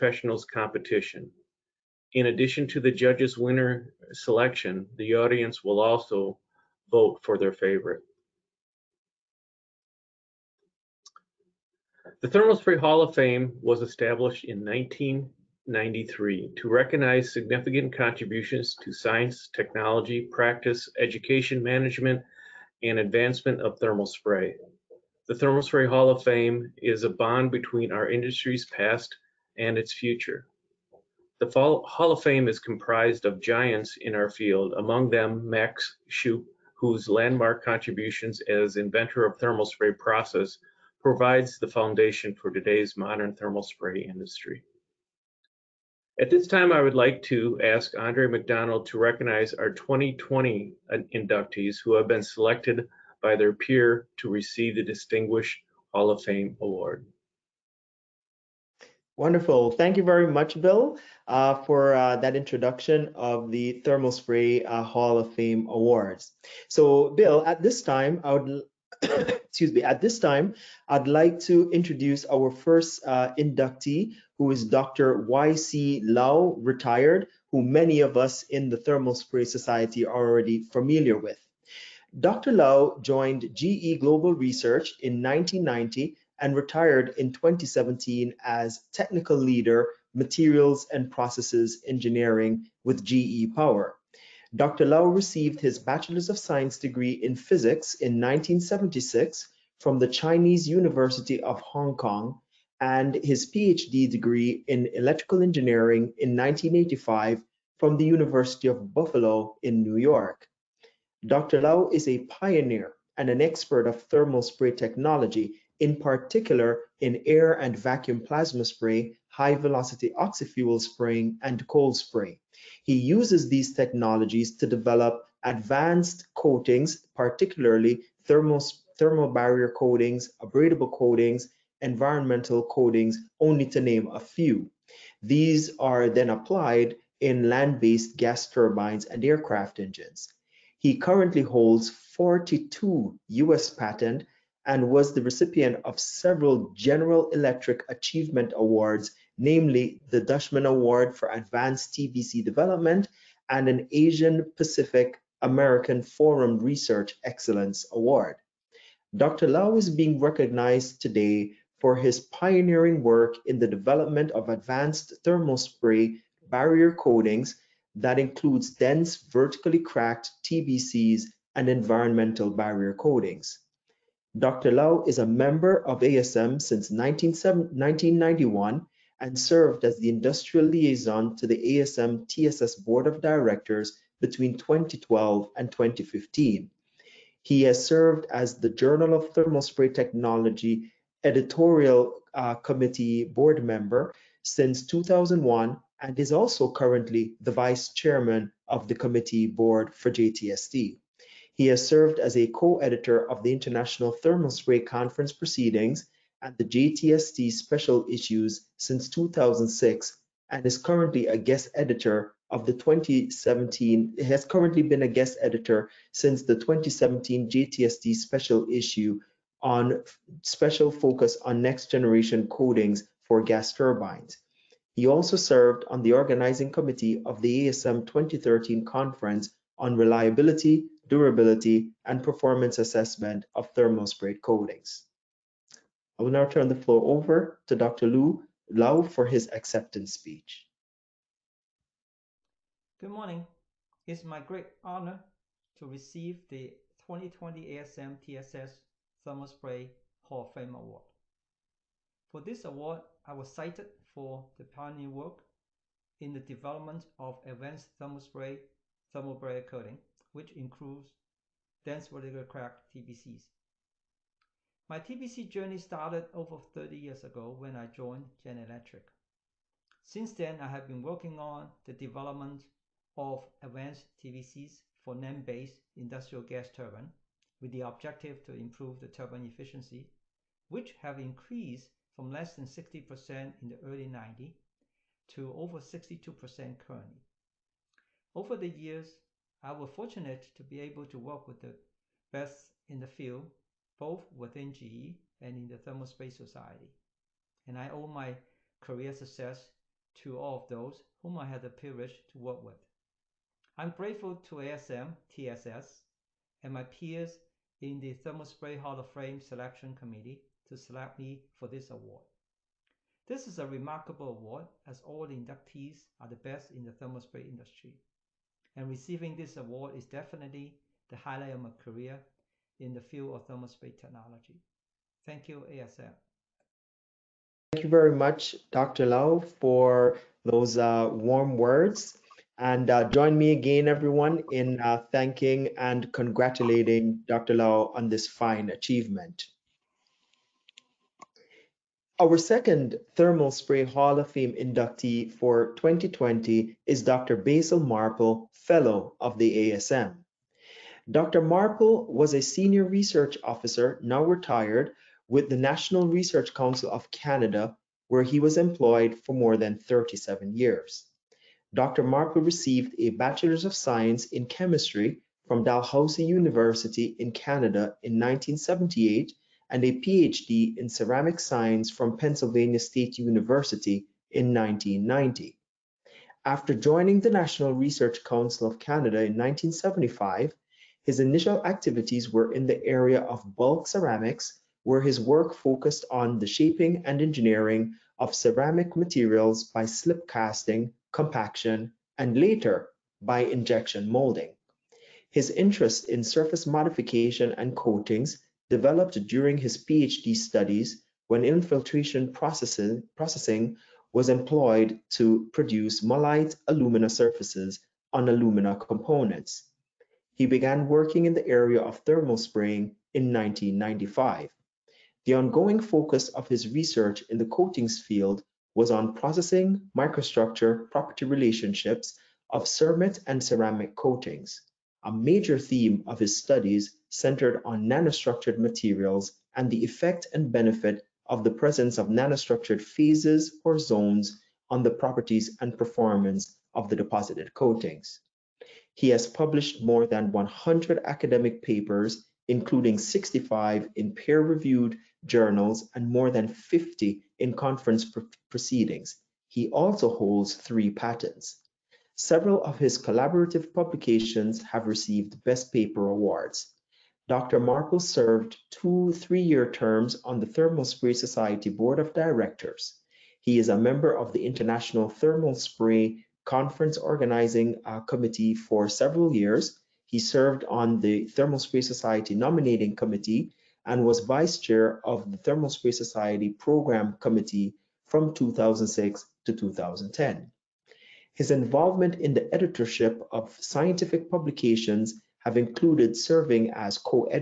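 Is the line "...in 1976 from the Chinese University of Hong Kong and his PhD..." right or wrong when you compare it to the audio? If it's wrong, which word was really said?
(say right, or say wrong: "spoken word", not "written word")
right.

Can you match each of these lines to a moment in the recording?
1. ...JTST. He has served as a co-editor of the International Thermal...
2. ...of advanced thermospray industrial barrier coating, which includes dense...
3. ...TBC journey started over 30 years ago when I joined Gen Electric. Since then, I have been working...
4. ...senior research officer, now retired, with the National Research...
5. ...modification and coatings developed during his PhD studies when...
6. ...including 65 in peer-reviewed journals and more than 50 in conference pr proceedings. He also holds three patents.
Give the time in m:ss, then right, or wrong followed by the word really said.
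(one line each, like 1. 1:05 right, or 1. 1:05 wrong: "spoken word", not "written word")
1. 3:20 right
2. 4:17 wrong: "thermal", not "industrial"
3. 4:24 right
4. 5:52 right
5. 6:36 right
6. 7:22 right.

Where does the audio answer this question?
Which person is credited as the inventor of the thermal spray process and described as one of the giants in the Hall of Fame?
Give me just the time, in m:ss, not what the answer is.
0:35.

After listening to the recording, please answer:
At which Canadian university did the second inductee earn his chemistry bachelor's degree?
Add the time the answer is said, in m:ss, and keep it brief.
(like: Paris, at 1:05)
Dalhousie University, at 6:05.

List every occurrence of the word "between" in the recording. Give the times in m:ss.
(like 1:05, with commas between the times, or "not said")
0:27, 3:04.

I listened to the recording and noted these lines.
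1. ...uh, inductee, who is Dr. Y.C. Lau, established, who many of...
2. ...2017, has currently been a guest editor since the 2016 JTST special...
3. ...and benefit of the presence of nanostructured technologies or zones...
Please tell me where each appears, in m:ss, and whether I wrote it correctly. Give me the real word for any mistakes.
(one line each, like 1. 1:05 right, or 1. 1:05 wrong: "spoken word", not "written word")
1. 1:13 wrong: "retired", not "established"
2. 3:32 wrong: "2017", not "2016"
3. 7:10 wrong: "phases", not "technologies".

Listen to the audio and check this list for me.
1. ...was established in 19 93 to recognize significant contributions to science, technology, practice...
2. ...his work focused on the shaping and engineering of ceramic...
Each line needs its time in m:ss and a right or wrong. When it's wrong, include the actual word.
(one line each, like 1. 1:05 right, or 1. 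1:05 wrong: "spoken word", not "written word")
1. 0:13 right
2. 6:25 right.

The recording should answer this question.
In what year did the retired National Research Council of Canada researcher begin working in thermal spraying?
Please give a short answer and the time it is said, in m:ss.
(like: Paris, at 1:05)
1995, at 6:53.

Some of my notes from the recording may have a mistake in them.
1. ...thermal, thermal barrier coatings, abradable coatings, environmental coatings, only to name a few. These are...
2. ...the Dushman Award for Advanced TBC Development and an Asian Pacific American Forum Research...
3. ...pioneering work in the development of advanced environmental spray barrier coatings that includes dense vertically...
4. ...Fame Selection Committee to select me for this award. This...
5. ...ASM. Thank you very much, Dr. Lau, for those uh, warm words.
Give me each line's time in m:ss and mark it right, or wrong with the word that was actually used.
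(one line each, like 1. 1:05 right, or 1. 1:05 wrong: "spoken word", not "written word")
1. 2:08 right
2. 2:30 right
3. 2:42 wrong: "thermal", not "environmental"
4. 5:09 right
5. 5:25 right.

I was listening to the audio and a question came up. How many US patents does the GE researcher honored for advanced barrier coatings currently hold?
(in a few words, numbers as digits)
42.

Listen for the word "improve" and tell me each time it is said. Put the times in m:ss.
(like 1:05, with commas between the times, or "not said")
4:38.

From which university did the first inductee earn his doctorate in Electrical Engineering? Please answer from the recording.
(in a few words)
University of Buffalo.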